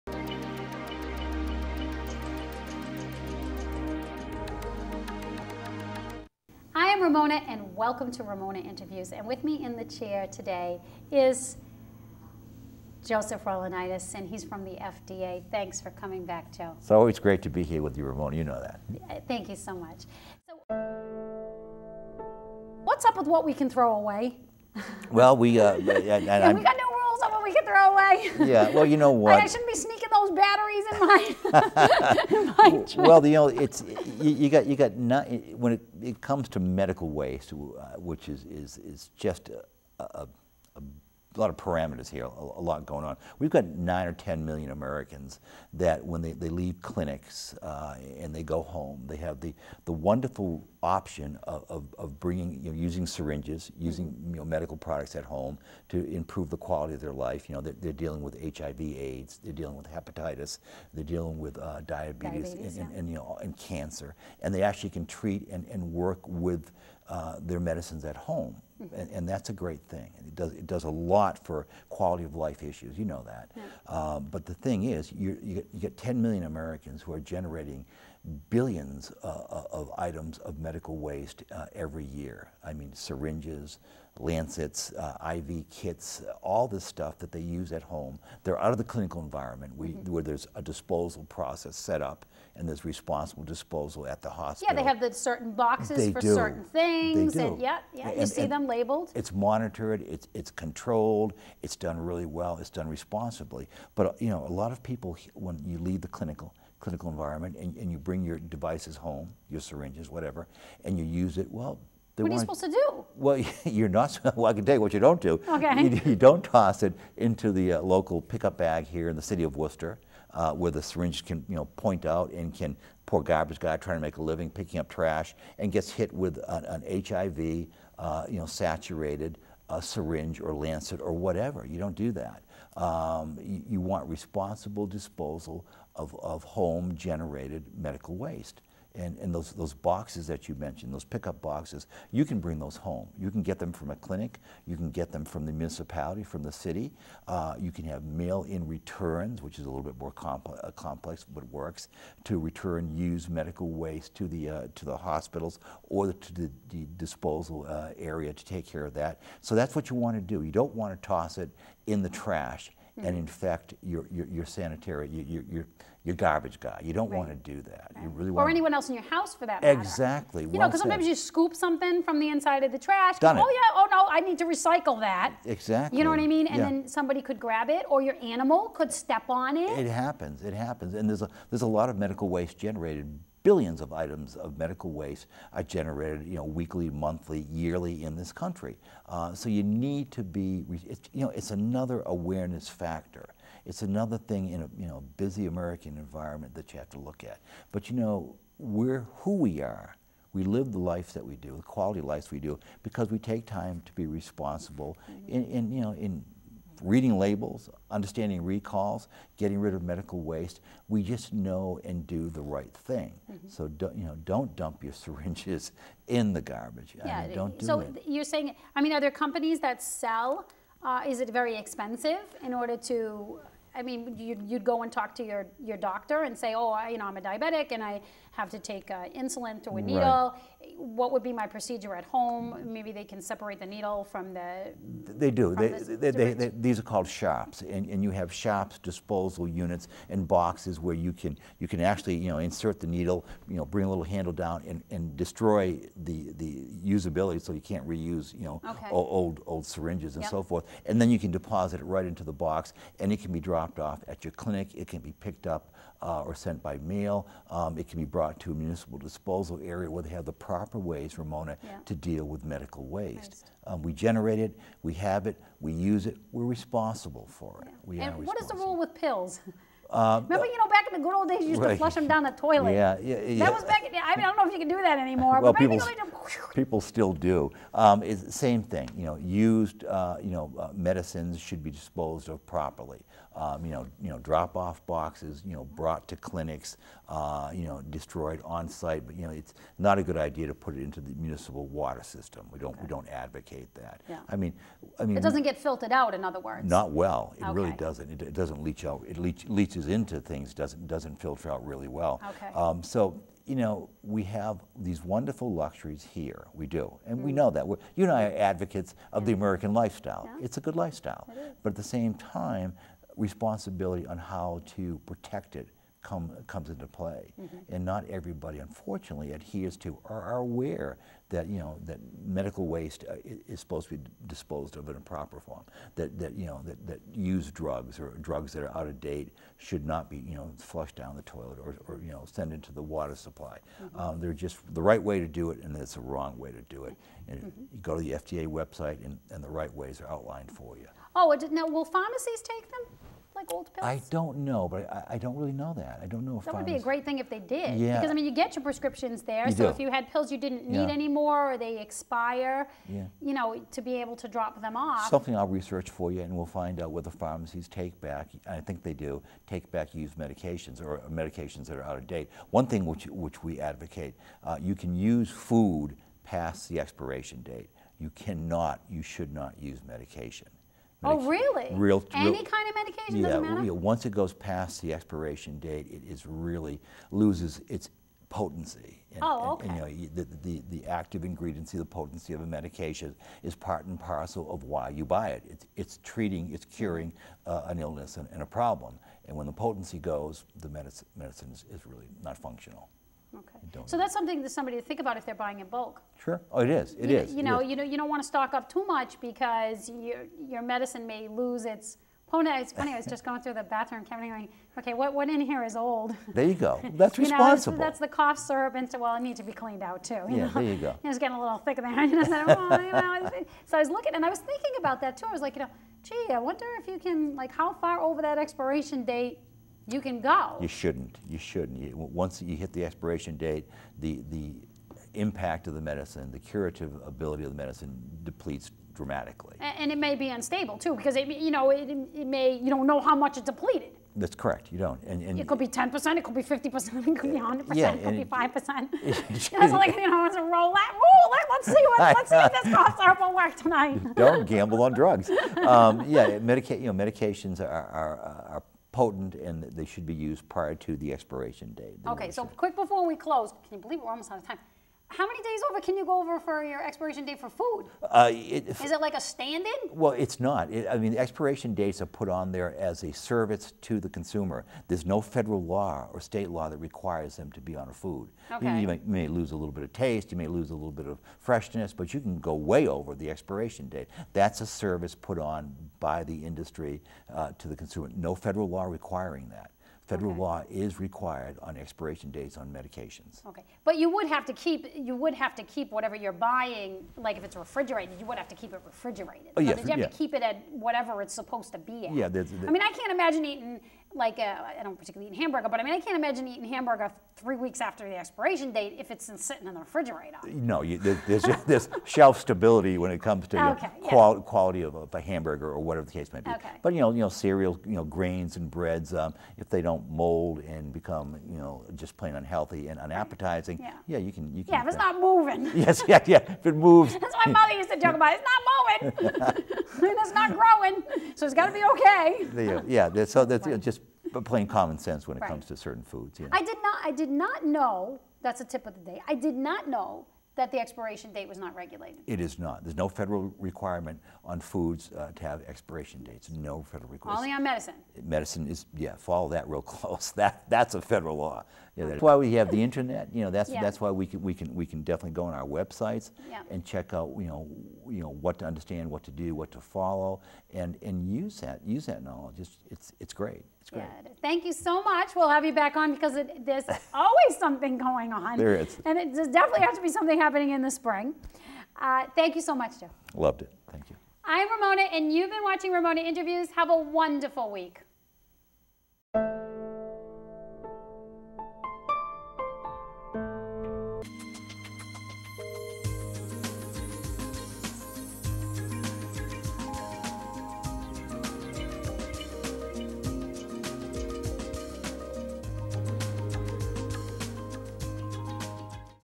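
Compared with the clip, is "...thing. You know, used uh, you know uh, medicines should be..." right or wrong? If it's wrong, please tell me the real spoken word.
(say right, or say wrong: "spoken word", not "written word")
right.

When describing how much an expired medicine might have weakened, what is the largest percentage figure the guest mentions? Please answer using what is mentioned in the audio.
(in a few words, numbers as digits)
100 percent.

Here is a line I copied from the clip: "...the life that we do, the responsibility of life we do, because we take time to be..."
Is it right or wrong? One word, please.
wrong.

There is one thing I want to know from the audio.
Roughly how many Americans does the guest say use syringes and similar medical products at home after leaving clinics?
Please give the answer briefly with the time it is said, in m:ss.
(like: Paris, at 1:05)
9 or 10 million, at 0:43.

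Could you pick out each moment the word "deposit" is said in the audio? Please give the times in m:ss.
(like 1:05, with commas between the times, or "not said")
4:11.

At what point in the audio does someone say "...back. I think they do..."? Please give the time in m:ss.
5:58.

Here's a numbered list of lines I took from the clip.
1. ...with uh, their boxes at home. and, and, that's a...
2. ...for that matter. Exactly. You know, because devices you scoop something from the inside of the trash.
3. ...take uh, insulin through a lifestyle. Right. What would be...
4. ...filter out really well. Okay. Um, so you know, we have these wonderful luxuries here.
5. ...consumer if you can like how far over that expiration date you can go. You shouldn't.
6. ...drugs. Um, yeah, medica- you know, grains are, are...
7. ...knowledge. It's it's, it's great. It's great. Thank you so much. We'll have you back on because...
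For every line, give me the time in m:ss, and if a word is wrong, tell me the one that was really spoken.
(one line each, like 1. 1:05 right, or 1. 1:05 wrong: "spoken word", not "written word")
1. 1:06 wrong: "medicines", not "boxes"
2. 2:49 wrong: "sometimes", not "devices"
3. 3:48 wrong: "needle", not "lifestyle"
4. 5:01 right
5. 6:56 wrong: "wonder", not "consumer"
6. 7:24 wrong: "medications", not "grains"
7. 9:12 right.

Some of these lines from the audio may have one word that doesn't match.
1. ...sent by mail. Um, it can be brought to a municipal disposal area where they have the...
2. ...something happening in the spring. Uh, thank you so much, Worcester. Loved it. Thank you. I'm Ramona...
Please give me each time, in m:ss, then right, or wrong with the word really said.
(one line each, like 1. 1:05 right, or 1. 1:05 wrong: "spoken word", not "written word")
1. 4:16 right
2. 9:20 wrong: "Joe", not "Worcester".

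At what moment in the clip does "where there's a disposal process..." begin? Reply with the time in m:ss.
1:30.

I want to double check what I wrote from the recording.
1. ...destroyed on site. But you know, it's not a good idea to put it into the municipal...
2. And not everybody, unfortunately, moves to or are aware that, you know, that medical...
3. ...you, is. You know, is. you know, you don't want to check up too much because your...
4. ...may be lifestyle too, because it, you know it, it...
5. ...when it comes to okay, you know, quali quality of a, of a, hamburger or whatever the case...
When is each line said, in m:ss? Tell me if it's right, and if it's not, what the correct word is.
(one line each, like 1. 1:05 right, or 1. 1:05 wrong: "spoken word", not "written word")
1. 4:47 right
2. 5:17 wrong: "adheres", not "moves"
3. 6:37 wrong: "stock", not "check"
4. 7:09 wrong: "unstable", not "lifestyle"
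5. 8:22 right.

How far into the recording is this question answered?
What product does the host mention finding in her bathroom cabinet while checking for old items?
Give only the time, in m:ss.
6:47.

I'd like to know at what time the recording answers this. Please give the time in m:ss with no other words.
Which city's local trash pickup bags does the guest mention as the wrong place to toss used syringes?
1:59.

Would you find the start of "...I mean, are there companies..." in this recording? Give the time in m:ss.
3:38.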